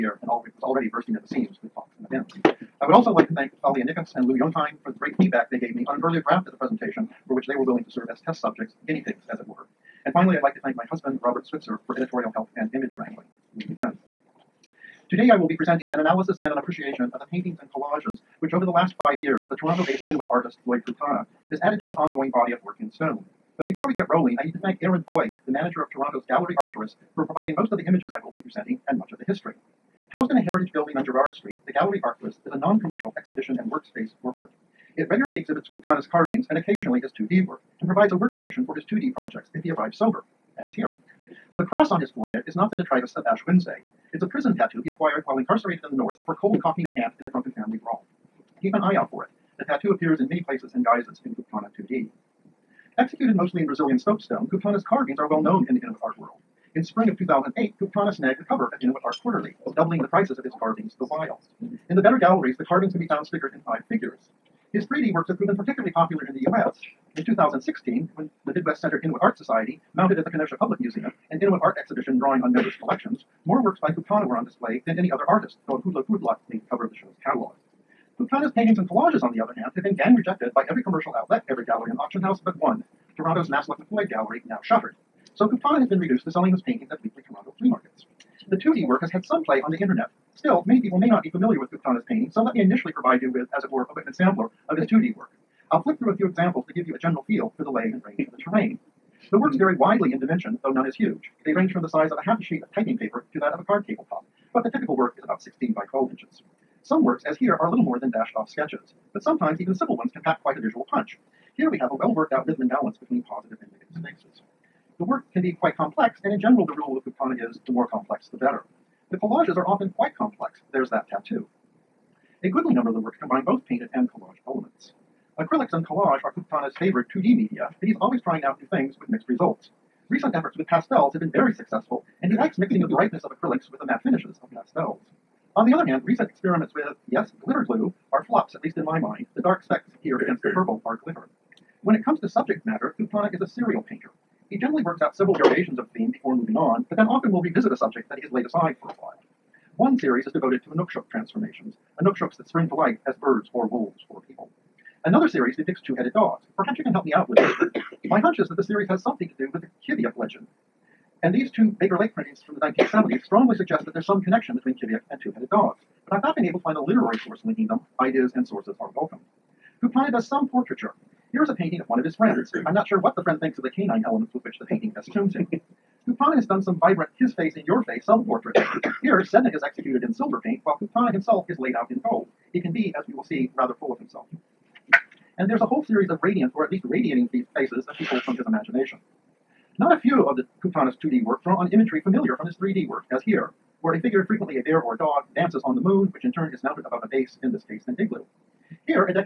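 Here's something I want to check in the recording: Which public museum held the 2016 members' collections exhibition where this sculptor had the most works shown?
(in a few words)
Kenosha Public Museum.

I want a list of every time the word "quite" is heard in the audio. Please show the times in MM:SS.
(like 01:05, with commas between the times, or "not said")
01:50, 01:55, 01:59.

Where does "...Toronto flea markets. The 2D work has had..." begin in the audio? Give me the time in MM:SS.
01:27.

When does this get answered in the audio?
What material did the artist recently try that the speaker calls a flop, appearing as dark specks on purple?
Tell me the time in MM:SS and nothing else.
02:17.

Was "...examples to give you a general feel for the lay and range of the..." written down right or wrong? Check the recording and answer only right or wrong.
right.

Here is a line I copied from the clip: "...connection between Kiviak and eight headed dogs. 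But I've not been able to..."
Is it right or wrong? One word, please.
wrong.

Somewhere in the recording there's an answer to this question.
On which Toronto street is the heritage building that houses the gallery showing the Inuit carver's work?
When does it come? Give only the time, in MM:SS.
00:31.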